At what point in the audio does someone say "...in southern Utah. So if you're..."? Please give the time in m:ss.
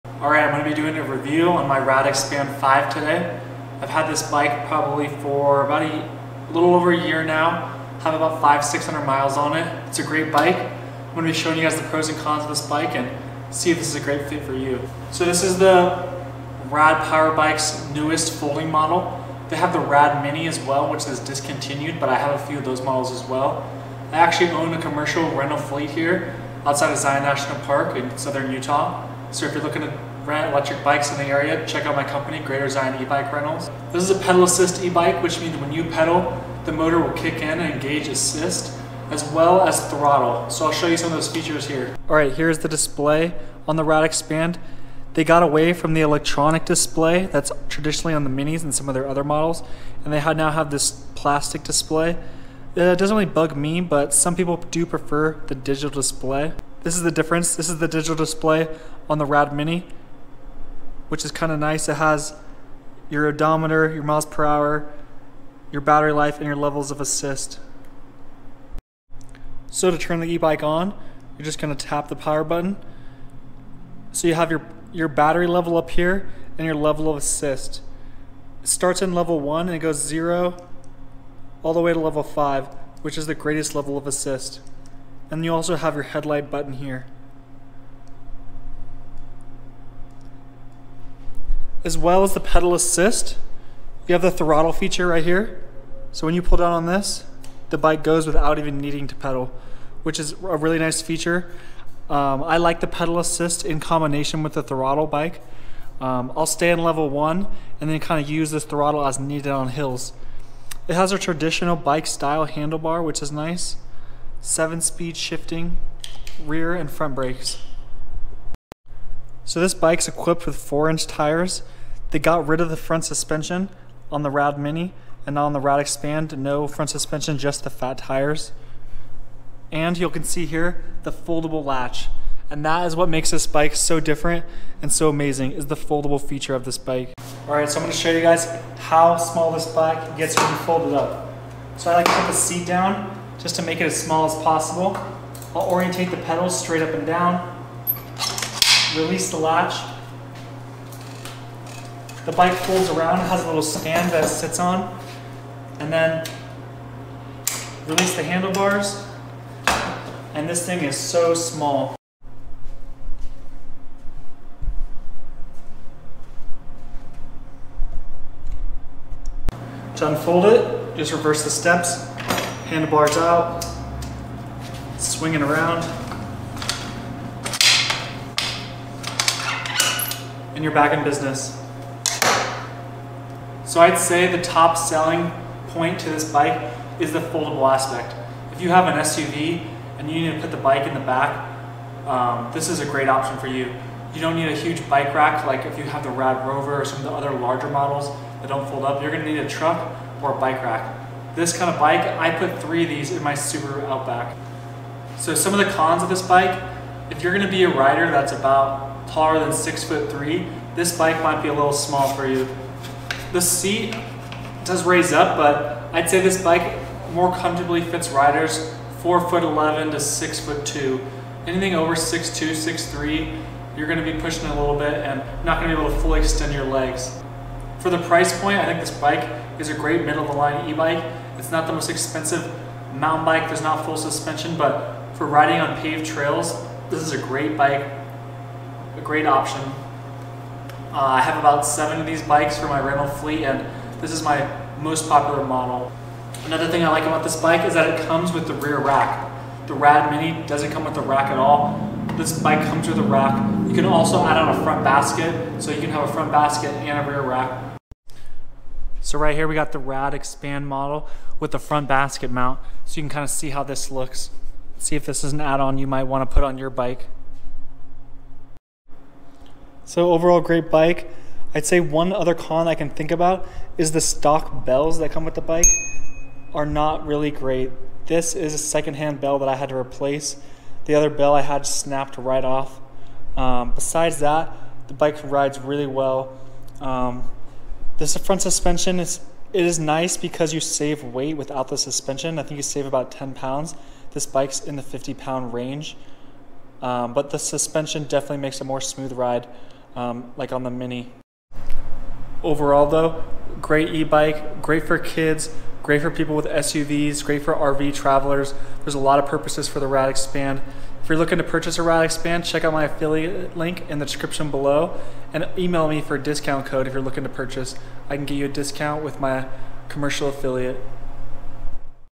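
0:27.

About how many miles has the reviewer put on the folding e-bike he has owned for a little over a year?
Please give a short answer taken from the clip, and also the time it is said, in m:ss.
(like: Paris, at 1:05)
500-600, at 0:08.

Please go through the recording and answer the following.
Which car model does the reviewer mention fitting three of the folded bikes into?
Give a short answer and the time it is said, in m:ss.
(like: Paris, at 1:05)
Subaru Outback, at 3:23.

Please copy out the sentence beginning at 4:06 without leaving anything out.
Another thing I like about this bike is that it comes with the rear rack.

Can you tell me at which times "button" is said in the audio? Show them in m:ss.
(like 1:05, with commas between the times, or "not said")
1:12, 1:26.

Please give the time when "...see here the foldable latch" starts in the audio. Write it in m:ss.
2:10.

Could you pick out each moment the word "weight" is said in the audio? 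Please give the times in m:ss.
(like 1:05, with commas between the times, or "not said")
4:51.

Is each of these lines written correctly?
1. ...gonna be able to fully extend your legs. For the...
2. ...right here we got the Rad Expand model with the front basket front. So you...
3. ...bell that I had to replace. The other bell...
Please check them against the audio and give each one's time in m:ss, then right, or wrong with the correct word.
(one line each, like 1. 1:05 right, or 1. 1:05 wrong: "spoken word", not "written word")
1. 3:45 right
2. 4:19 wrong: "mount", not "front"
3. 4:39 right.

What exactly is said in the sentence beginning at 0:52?
Uh, it doesn't really bug me, but some people do prefer the digital display.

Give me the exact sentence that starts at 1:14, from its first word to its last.
So you have your, your battery level up here and your level of assist.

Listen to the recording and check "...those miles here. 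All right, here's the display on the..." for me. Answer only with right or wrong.
wrong.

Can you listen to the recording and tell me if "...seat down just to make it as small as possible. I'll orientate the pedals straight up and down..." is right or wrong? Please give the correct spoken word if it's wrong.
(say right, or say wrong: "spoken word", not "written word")
right.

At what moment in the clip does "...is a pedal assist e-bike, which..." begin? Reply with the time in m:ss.
0:34.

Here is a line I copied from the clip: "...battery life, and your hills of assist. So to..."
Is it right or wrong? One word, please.
wrong.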